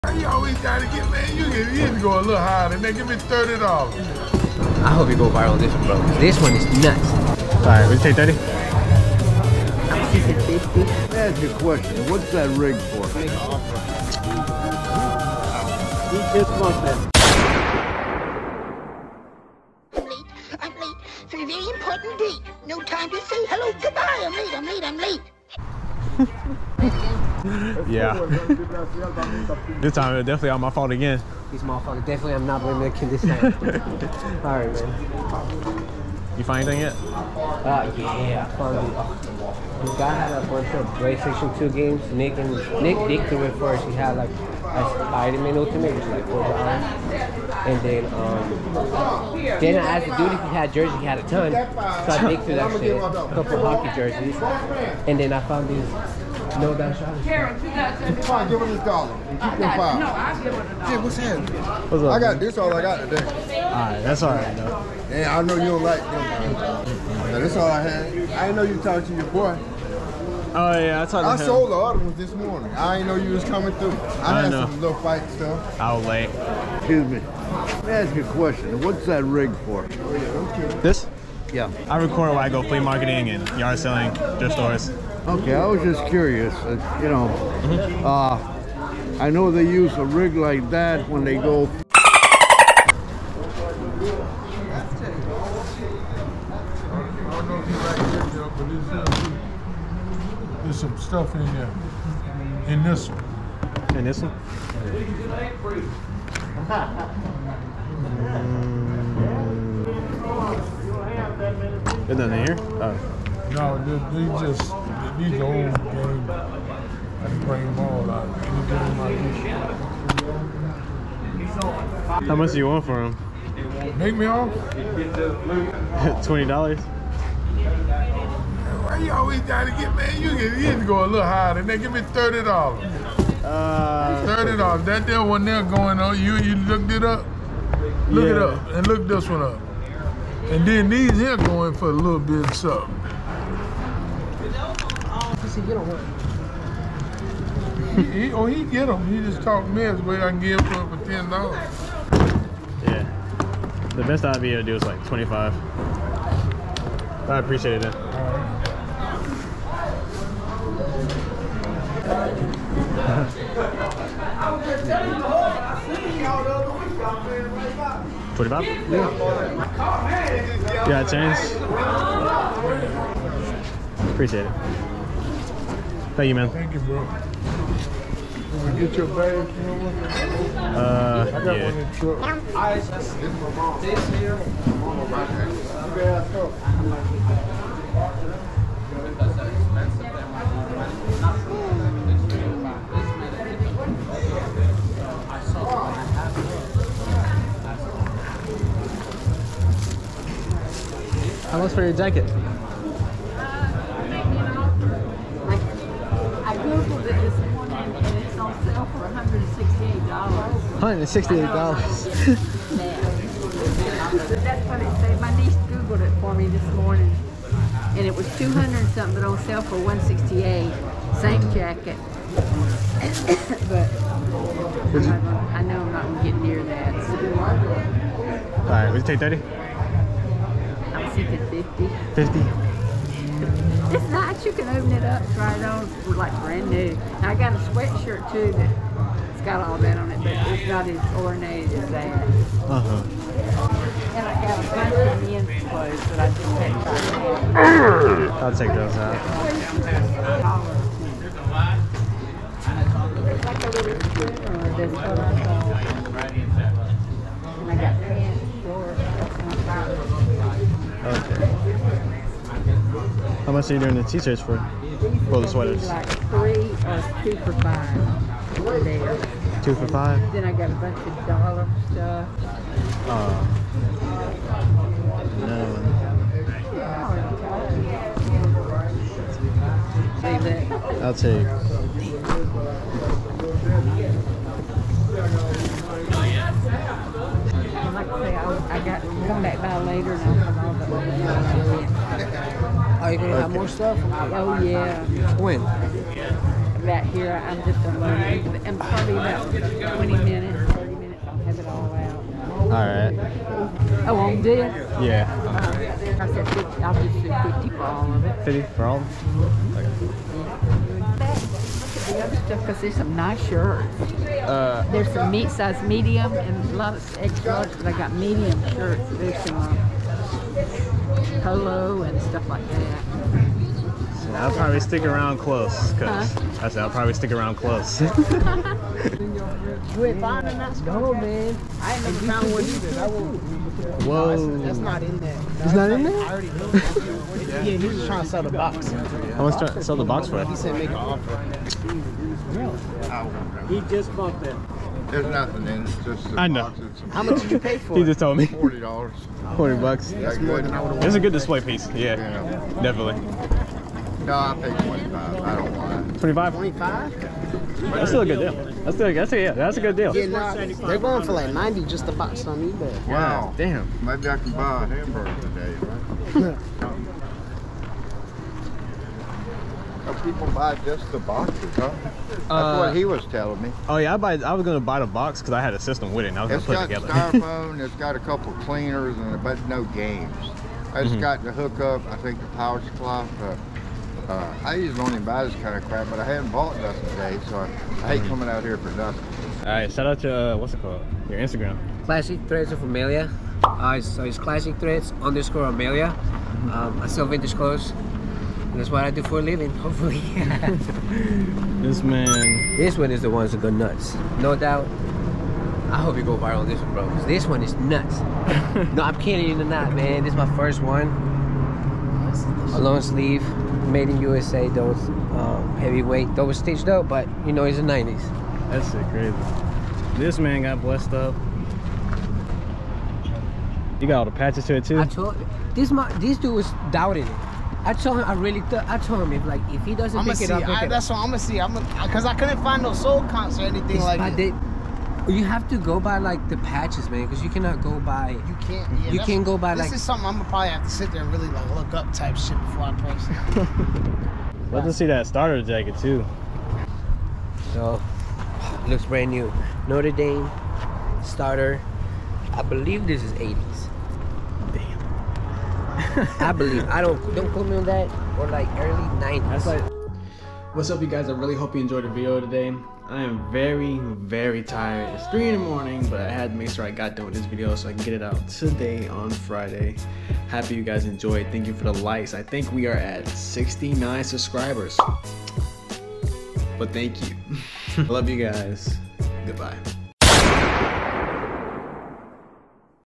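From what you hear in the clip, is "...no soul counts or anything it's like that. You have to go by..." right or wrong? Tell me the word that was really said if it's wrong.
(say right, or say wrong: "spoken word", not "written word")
right.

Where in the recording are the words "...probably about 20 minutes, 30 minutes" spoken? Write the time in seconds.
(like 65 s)
298 s.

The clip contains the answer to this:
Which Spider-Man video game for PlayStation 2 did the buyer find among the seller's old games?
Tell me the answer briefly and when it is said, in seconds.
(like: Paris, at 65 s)
Ultimate, at 45 s.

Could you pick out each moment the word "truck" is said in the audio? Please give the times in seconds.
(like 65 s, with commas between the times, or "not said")
181 s.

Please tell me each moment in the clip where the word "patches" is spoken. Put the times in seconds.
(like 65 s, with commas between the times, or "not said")
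424 s, 436 s.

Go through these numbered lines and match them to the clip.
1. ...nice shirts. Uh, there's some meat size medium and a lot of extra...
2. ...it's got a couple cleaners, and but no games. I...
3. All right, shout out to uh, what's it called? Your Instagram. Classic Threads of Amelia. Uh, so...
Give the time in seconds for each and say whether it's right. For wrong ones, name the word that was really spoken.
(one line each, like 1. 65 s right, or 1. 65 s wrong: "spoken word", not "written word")
1. 313 s right
2. 377 s right
3. 389 s right.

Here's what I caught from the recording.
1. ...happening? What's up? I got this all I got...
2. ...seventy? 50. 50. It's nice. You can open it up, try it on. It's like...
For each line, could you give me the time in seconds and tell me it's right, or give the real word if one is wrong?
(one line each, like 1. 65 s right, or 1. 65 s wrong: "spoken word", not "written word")
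1. 61 s right
2. 229 s wrong: "thirty", not "seventy".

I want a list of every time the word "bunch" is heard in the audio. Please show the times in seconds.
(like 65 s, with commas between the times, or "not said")
40 s, 244 s, 270 s.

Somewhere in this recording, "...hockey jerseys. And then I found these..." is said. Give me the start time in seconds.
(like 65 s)
53 s.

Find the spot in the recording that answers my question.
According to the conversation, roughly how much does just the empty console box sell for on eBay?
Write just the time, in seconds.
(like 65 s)
361 s.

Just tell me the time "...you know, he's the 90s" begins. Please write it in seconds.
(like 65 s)
417 s.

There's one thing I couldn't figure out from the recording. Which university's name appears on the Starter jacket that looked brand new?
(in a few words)
Notre Dame.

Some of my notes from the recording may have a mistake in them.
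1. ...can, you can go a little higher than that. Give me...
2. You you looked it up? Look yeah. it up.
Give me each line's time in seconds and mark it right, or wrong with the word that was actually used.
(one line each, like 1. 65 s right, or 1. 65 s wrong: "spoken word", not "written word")
1. 130 s right
2. 136 s right.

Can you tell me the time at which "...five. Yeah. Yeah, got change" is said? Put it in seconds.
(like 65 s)
168 s.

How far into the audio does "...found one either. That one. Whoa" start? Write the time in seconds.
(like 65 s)
332 s.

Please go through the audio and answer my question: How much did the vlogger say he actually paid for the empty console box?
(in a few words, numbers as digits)
$25.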